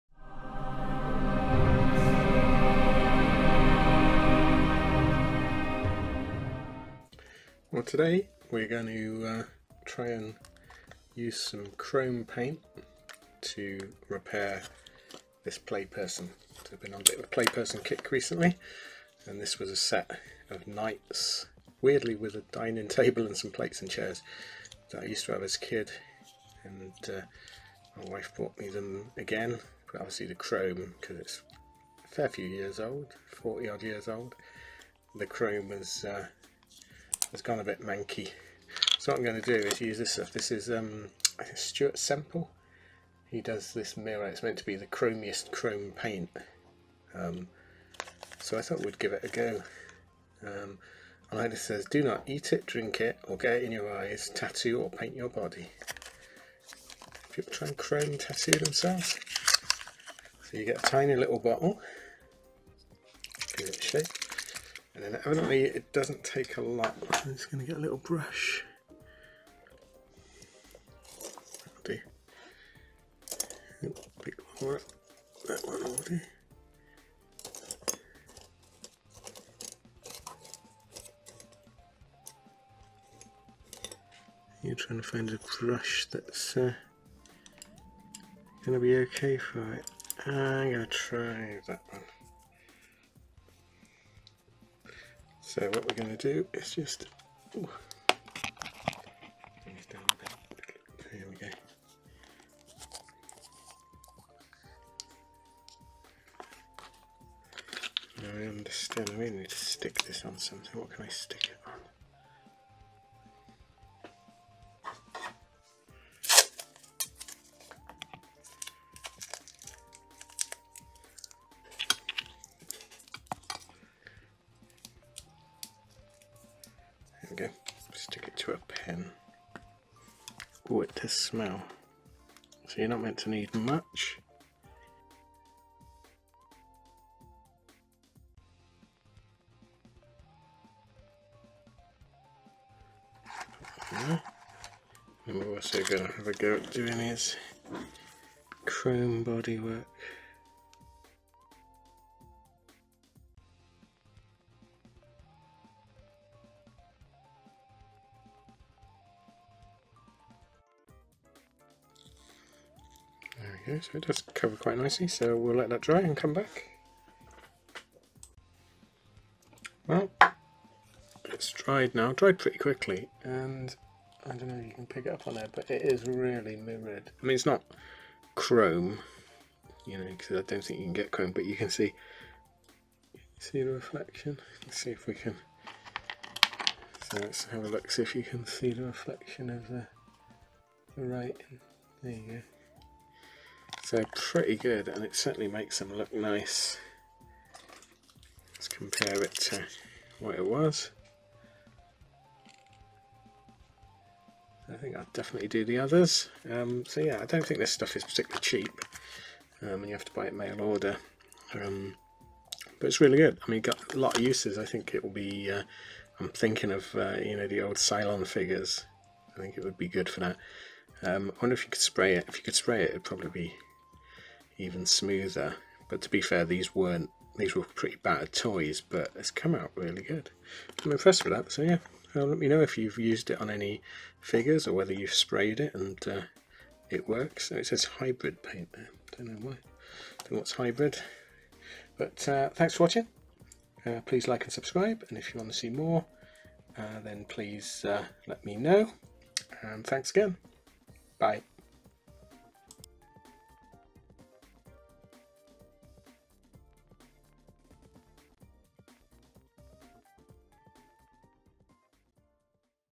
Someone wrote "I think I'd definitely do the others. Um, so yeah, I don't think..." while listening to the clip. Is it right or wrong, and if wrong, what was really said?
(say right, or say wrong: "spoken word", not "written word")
right.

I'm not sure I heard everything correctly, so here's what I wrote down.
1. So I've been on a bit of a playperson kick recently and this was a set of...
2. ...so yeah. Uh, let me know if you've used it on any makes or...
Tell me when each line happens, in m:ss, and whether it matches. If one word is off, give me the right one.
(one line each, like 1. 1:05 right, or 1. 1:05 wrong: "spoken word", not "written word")
1. 0:16 right
2. 3:51 wrong: "figures", not "makes".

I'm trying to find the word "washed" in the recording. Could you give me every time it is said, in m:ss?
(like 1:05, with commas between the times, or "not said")
not said.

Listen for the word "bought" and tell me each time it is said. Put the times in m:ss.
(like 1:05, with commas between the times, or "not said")
0:28.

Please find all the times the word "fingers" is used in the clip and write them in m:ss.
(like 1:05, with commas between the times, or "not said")
not said.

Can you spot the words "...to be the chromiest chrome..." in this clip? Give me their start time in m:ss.
0:44.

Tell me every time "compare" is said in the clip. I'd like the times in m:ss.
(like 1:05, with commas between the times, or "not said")
3:18.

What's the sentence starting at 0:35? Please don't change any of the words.
The chrome was uh, has gone a bit manky.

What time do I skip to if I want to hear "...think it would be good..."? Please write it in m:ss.
3:39.